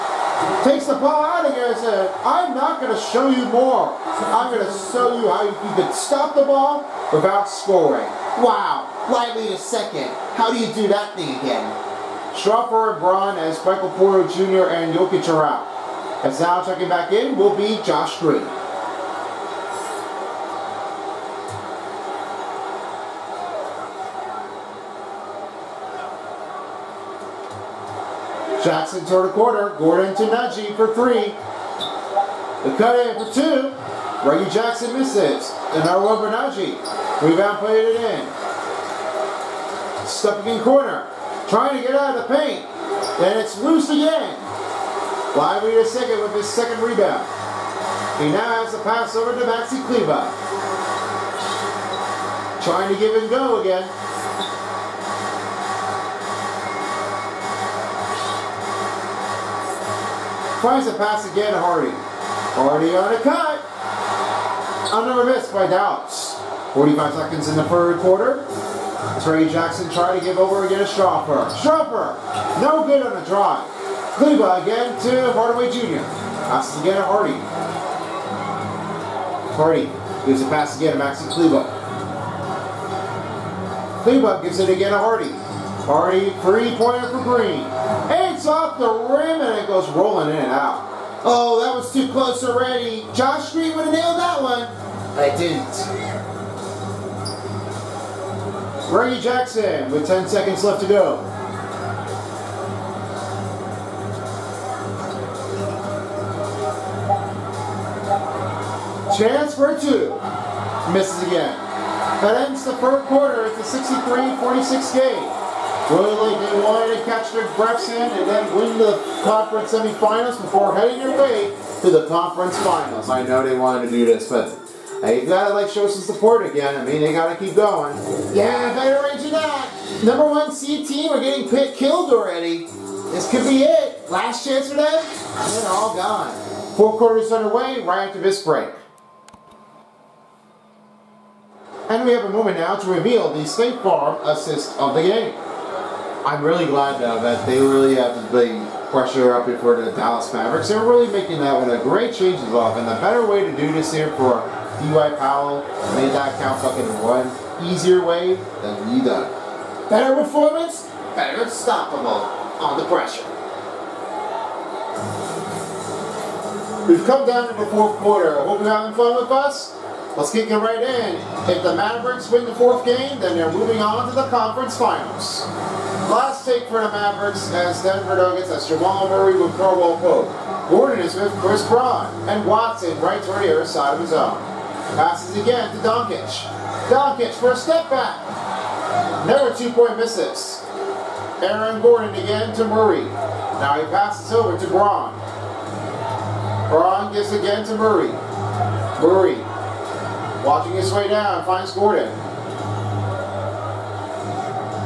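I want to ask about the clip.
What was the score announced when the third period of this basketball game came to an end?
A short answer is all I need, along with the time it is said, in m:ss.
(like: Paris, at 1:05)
63-46, at 1:53.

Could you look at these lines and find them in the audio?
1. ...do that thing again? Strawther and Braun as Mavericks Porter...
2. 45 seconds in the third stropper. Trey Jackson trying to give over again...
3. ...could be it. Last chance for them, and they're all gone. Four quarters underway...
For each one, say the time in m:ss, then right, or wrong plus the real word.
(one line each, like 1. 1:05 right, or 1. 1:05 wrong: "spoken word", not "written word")
1. 0:10 wrong: "Michael", not "Mavericks"
2. 1:06 wrong: "quarter", not "stropper"
3. 2:13 right.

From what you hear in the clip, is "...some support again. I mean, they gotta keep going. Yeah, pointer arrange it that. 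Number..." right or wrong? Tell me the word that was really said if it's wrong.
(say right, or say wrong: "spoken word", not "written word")
wrong: "better", not "pointer".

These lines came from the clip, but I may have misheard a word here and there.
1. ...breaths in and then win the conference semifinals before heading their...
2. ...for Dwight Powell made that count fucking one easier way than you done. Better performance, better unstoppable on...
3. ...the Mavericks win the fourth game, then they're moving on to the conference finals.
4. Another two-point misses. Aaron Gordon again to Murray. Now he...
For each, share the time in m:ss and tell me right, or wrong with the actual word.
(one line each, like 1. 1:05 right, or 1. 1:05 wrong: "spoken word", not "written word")
1. 1:57 right
2. 2:34 right
3. 2:51 right
4. 3:09 right.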